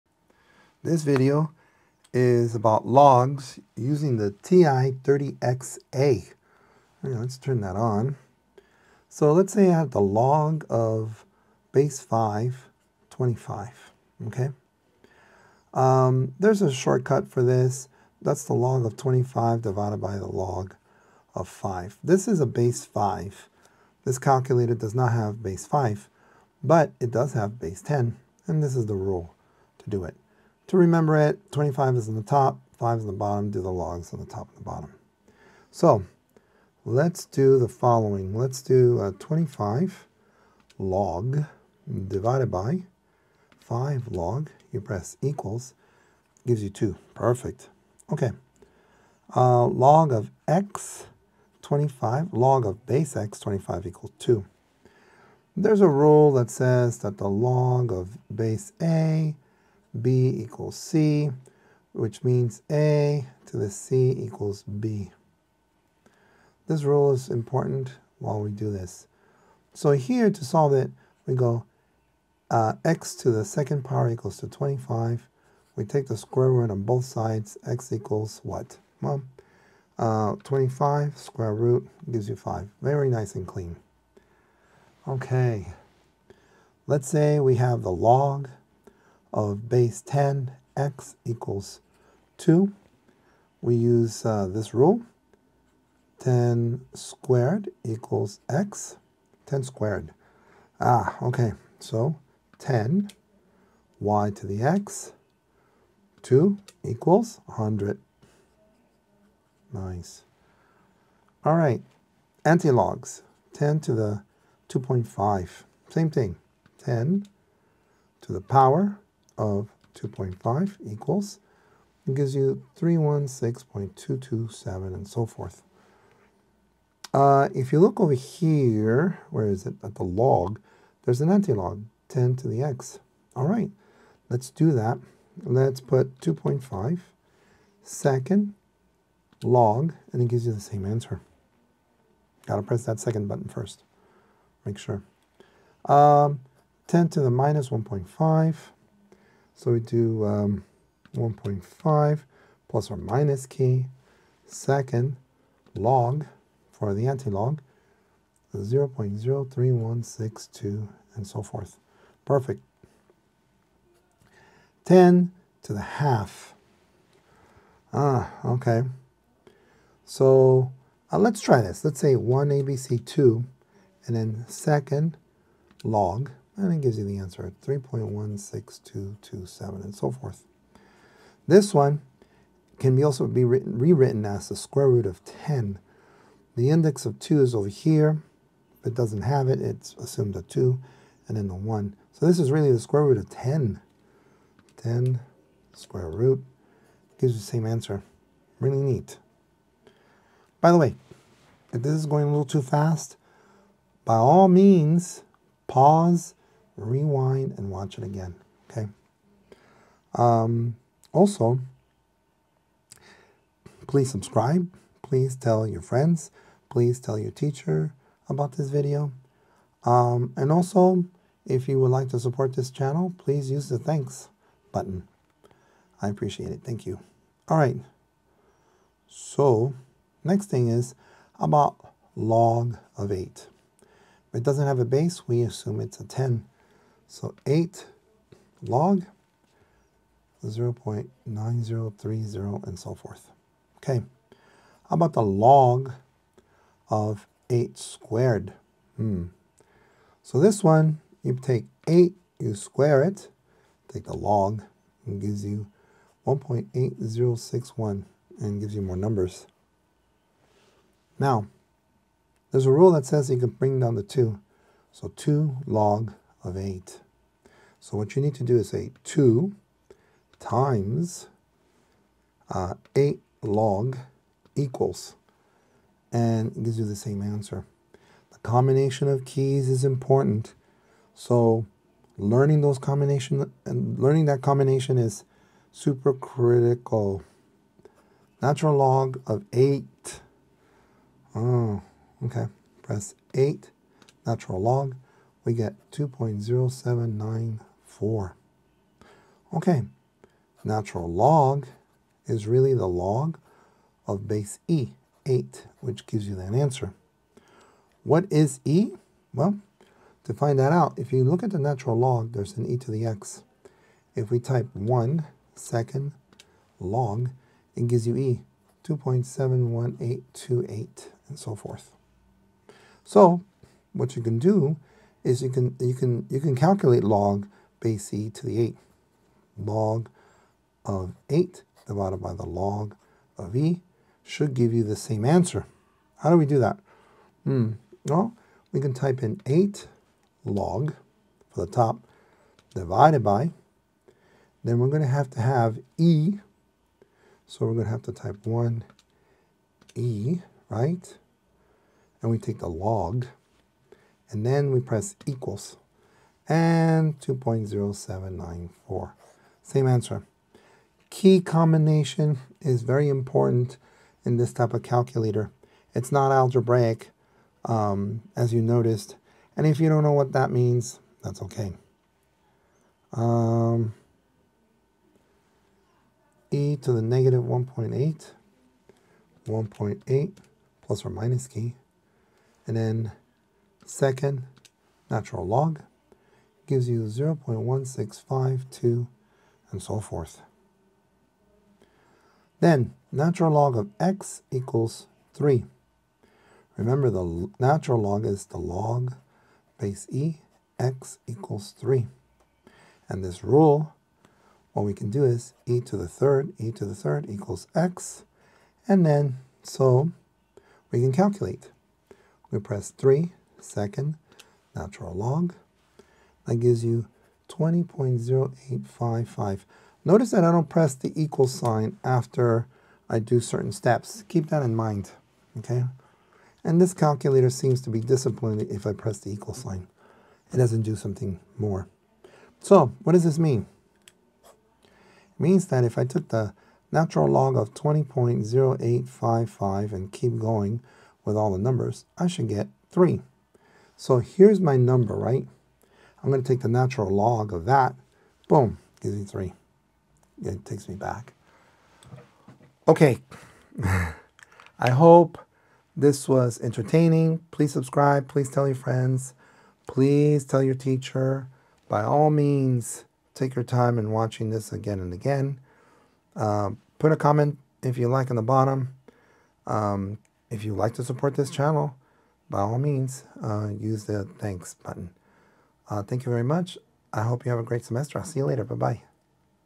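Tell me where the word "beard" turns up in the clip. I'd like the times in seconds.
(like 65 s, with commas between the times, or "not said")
not said.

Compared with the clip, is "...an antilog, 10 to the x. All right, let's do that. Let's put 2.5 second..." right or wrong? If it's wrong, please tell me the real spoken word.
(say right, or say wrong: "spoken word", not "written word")
right.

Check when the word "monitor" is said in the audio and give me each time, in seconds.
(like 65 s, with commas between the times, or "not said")
not said.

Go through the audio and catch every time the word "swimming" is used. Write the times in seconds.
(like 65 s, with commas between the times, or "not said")
not said.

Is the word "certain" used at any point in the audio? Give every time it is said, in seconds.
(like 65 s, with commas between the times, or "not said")
423 s.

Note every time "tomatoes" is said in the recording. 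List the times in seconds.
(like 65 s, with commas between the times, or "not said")
not said.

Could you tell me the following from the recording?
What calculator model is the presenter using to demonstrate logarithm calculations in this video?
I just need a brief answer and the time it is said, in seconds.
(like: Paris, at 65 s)
TI-30XA, at 4 s.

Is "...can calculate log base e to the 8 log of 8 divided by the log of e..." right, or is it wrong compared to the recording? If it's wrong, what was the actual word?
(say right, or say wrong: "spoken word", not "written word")
right.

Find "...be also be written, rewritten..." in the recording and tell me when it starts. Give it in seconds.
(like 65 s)
182 s.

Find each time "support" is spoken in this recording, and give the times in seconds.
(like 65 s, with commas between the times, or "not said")
222 s, 471 s.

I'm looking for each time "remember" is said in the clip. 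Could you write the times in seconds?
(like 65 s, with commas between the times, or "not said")
30 s, 396 s.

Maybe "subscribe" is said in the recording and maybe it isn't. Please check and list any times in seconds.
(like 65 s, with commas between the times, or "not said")
214 s, 457 s.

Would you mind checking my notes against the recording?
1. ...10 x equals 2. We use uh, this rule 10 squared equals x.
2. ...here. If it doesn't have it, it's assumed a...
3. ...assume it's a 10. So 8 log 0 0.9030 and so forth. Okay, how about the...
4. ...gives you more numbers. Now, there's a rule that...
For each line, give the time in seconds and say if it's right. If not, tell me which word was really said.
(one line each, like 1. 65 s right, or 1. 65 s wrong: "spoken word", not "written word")
1. 90 s right
2. 187 s right
3. 235 s right
4. 258 s right.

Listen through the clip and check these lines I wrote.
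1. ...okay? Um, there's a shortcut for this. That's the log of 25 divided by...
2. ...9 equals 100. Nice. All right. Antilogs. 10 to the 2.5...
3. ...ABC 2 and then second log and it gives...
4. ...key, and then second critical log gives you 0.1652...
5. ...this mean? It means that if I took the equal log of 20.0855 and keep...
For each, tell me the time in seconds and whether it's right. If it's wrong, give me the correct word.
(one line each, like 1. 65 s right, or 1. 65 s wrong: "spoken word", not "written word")
1. 14 s right
2. 106 s wrong: "2", not "9"
3. 172 s right
4. 381 s wrong: "natural", not "critical"
5. 433 s wrong: "natural", not "equal".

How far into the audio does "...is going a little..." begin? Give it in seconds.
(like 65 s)
201 s.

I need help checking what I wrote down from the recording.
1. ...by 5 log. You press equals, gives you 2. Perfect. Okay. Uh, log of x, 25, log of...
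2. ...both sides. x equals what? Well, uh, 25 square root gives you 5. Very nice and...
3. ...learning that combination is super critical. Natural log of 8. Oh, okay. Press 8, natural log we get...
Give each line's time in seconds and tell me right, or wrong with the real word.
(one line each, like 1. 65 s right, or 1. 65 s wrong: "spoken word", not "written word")
1. 42 s right
2. 76 s right
3. 283 s right.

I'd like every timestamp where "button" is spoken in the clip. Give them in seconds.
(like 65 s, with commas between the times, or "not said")
143 s, 224 s, 474 s.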